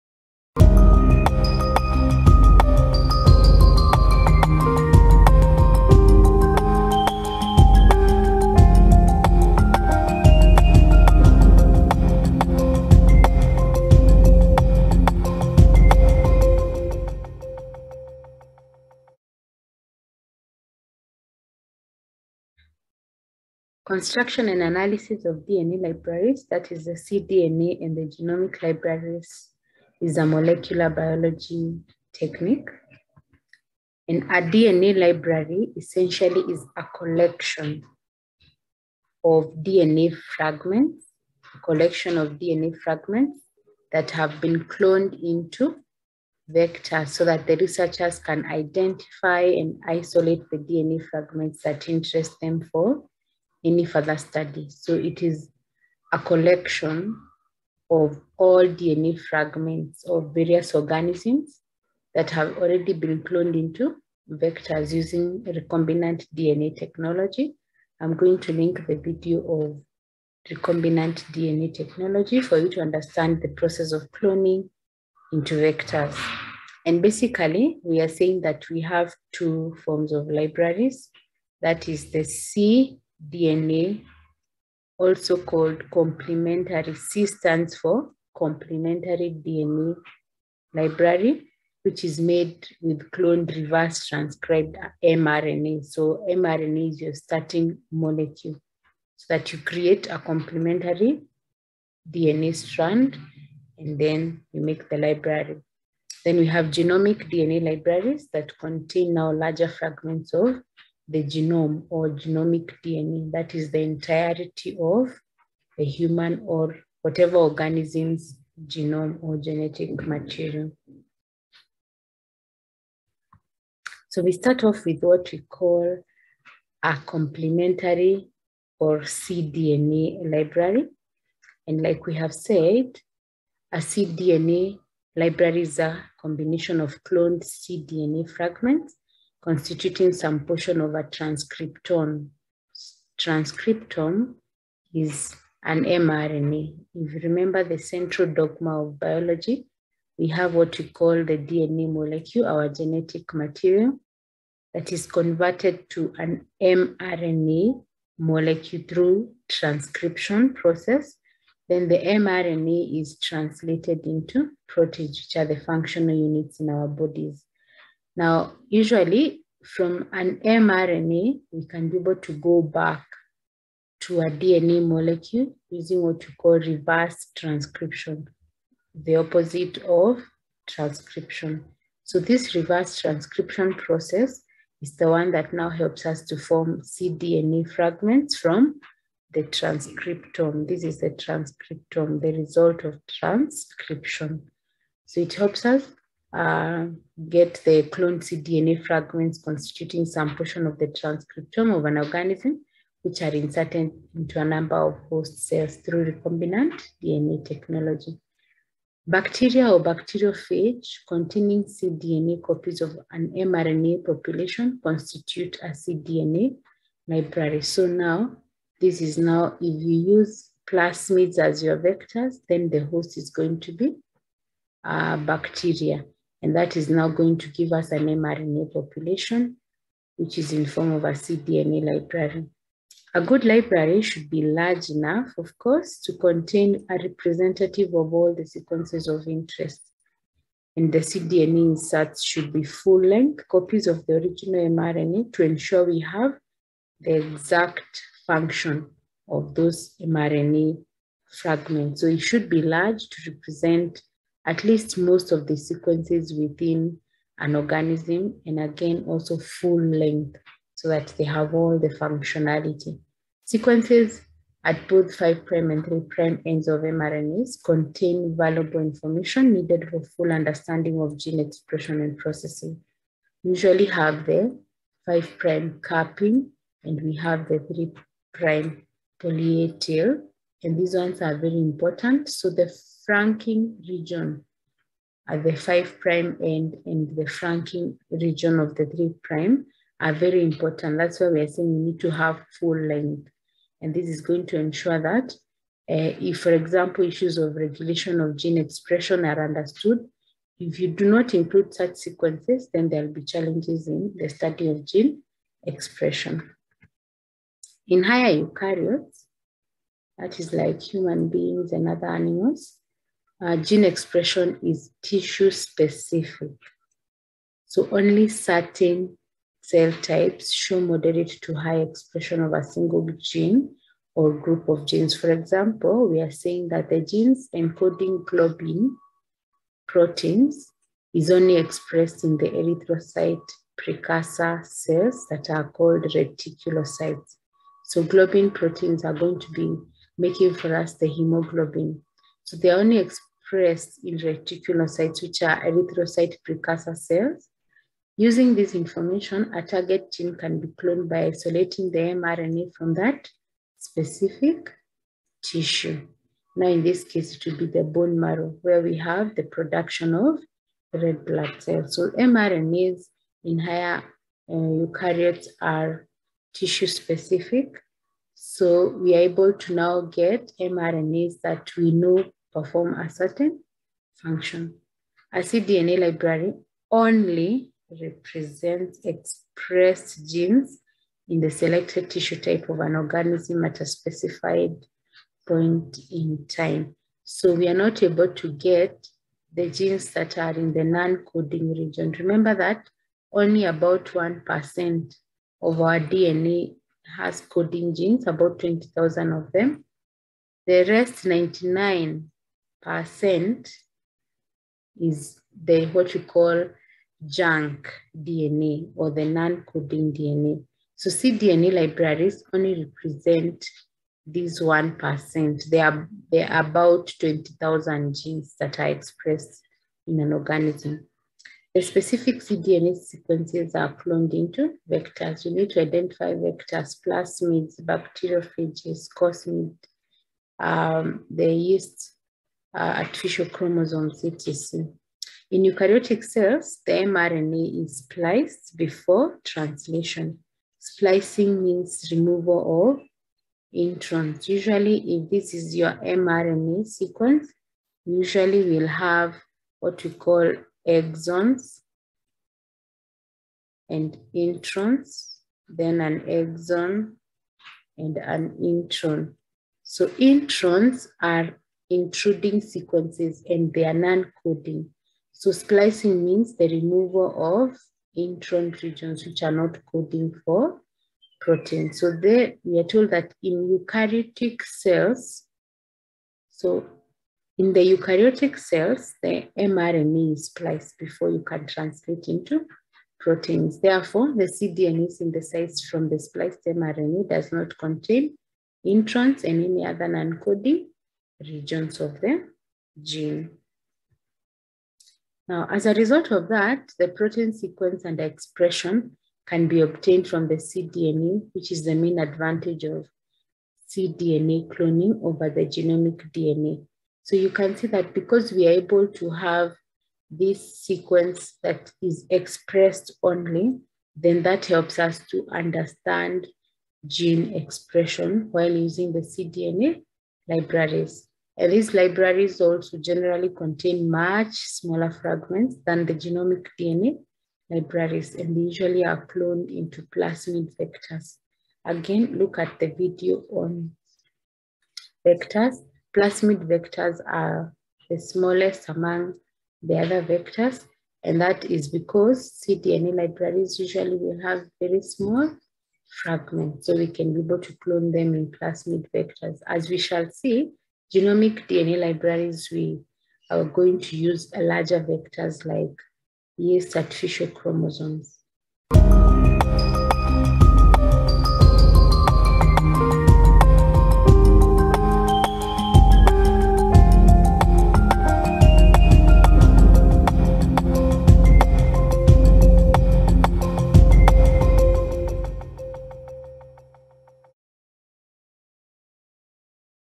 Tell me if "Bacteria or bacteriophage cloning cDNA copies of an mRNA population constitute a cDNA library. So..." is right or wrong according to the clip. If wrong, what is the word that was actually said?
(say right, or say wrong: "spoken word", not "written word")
wrong: "containing", not "cloning".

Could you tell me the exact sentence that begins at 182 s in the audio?
So this reverse transcription process is the one that now helps us to form cDNA fragments from the transcriptome.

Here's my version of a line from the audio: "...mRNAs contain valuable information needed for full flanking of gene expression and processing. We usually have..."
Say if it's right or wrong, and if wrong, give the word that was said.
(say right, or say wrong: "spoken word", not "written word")
wrong: "understanding", not "flanking".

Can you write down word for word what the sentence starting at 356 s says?
Now, in this case, it will be the bone marrow where we have the production of red blood cells.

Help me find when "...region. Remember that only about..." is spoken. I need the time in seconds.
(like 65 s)
391 s.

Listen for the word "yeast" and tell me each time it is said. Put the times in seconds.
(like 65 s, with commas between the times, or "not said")
431 s, 556 s.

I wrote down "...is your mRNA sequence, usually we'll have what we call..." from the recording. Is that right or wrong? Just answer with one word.
right.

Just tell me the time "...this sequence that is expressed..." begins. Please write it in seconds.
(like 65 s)
510 s.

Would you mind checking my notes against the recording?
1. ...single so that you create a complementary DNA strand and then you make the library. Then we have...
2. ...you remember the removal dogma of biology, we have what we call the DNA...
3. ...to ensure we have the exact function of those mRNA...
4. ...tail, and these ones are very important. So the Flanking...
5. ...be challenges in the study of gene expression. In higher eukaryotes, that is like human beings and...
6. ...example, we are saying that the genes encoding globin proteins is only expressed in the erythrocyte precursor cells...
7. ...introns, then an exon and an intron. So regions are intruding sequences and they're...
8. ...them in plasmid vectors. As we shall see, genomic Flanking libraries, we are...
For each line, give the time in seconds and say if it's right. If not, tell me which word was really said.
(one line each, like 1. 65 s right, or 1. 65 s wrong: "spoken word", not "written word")
1. 97 s wrong: "molecule", not "single"
2. 147 s wrong: "central", not "removal"
3. 245 s right
4. 279 s right
5. 303 s right
6. 325 s right
7. 454 s wrong: "introns", not "regions"
8. 548 s wrong: "DNA", not "Flanking".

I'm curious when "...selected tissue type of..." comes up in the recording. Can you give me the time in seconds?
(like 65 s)
381 s.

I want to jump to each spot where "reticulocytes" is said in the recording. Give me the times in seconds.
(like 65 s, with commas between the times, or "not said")
336 s, 344 s.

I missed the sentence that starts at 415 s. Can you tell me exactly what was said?
There are, there are about 20,000 genes that are expressed in an organism.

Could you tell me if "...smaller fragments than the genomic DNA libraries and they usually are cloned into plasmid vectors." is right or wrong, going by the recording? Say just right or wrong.
right.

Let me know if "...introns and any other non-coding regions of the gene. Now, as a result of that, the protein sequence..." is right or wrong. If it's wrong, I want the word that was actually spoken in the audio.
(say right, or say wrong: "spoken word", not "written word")
right.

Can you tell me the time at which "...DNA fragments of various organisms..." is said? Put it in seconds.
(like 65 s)
58 s.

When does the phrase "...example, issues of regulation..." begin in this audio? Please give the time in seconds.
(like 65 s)
296 s.